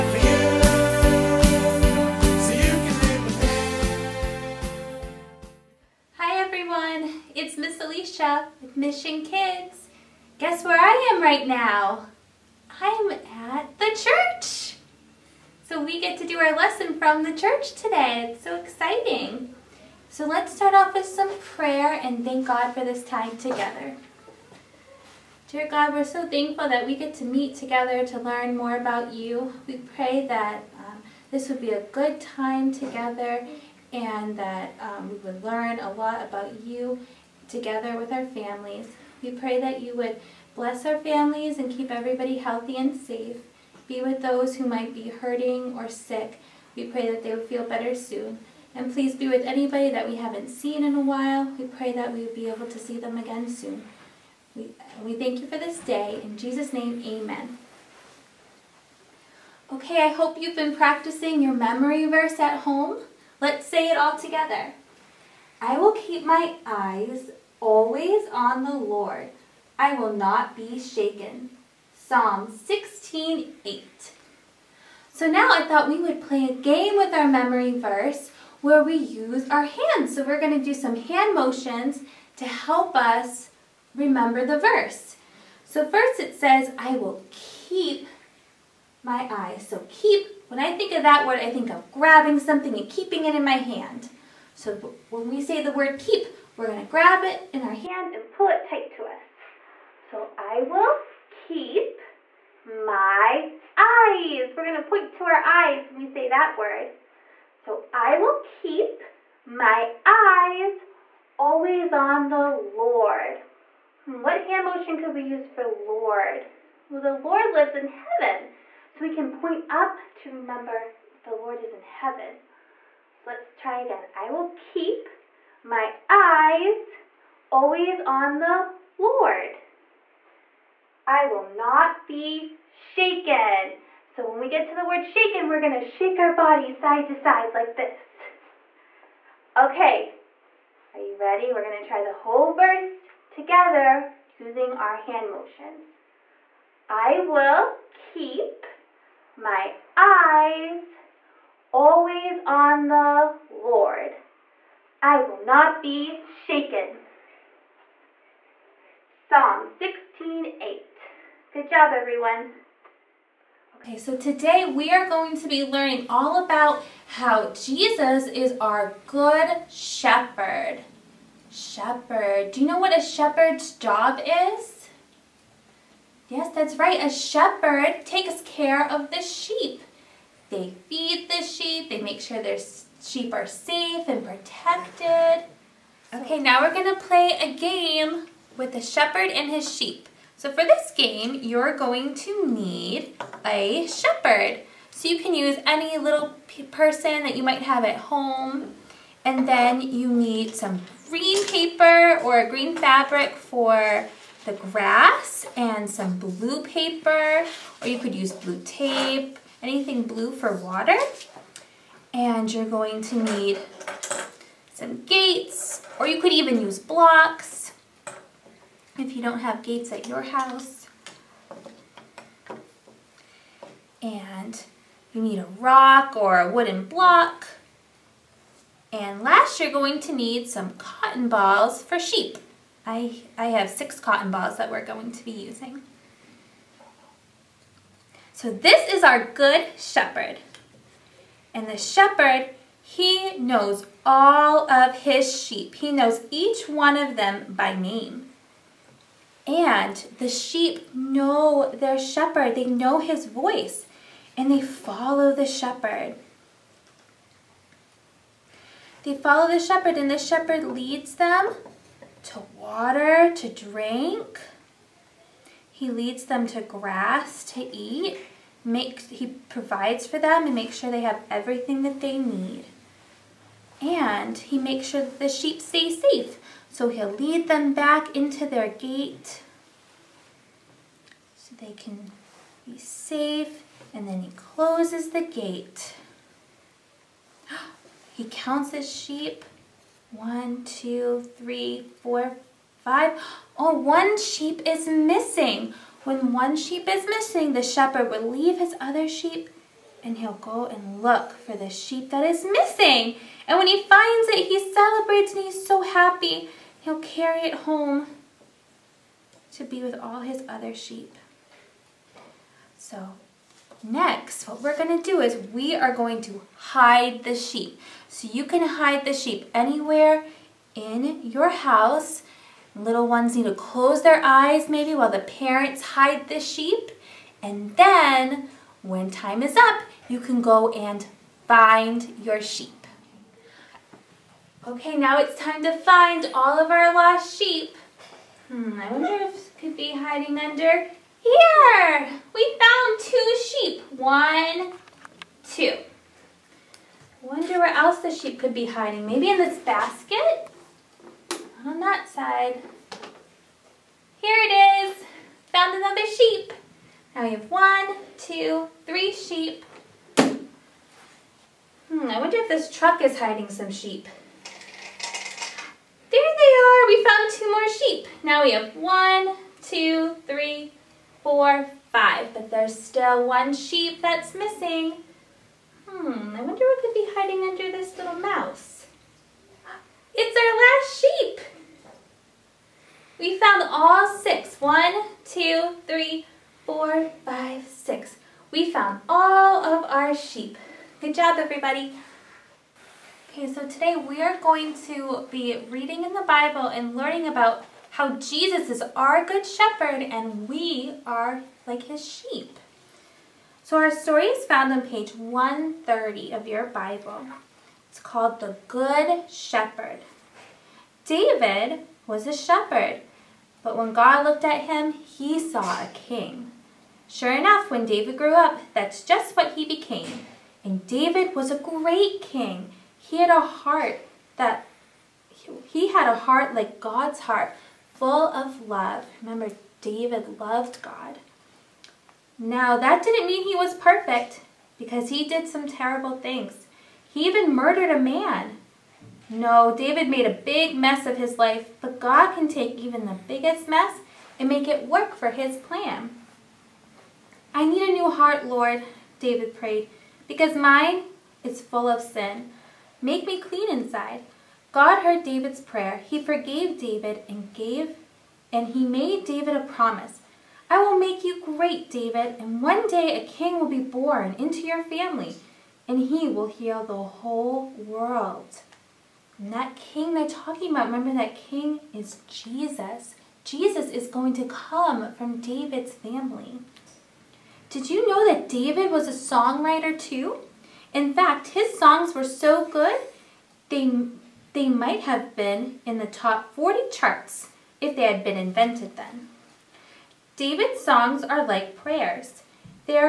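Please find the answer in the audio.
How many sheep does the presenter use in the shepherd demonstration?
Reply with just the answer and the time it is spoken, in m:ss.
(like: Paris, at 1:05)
6, at 3:53.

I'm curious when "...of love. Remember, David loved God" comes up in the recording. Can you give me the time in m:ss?
7:08.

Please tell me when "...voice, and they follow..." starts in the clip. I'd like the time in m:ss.
4:13.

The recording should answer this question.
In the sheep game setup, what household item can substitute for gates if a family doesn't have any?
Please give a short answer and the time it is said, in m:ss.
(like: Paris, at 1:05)
Blocks, at 3:36.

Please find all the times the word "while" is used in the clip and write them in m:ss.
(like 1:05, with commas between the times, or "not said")
0:50, 5:24.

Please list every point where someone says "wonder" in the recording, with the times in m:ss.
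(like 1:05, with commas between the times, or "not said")
5:38, 5:47, 6:02, 6:16.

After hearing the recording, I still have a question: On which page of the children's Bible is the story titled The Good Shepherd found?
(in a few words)
130.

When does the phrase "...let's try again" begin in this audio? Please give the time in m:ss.
2:03.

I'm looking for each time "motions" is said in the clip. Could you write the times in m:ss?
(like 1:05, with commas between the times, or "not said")
1:21, 1:54, 2:25.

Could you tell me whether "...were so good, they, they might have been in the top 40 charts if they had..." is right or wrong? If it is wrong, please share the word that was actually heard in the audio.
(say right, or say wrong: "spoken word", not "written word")
right.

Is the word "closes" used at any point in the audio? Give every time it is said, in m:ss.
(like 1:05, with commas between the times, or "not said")
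4:44, 5:23.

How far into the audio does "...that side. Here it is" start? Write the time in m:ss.
5:51.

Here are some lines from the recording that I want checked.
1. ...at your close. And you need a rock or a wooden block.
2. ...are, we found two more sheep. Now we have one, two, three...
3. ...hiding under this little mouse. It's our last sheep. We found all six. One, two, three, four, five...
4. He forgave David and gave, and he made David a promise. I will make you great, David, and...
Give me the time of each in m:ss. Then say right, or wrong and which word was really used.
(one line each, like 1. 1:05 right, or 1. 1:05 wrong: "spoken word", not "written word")
1. 3:39 wrong: "house", not "close"
2. 6:06 right
3. 6:17 right
4. 7:36 right.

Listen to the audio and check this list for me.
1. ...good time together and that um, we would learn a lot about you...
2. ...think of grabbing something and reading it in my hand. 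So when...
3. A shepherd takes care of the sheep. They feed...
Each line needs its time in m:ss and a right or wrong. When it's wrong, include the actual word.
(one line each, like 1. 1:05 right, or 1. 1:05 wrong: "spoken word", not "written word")
1. 0:31 right
2. 1:31 wrong: "keeping", not "reading"
3. 2:57 right.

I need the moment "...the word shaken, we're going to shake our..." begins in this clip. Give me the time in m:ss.
2:14.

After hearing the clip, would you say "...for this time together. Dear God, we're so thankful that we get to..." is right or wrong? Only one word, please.
right.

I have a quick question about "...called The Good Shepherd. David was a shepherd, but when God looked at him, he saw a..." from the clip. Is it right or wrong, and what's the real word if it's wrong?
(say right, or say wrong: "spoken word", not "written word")
right.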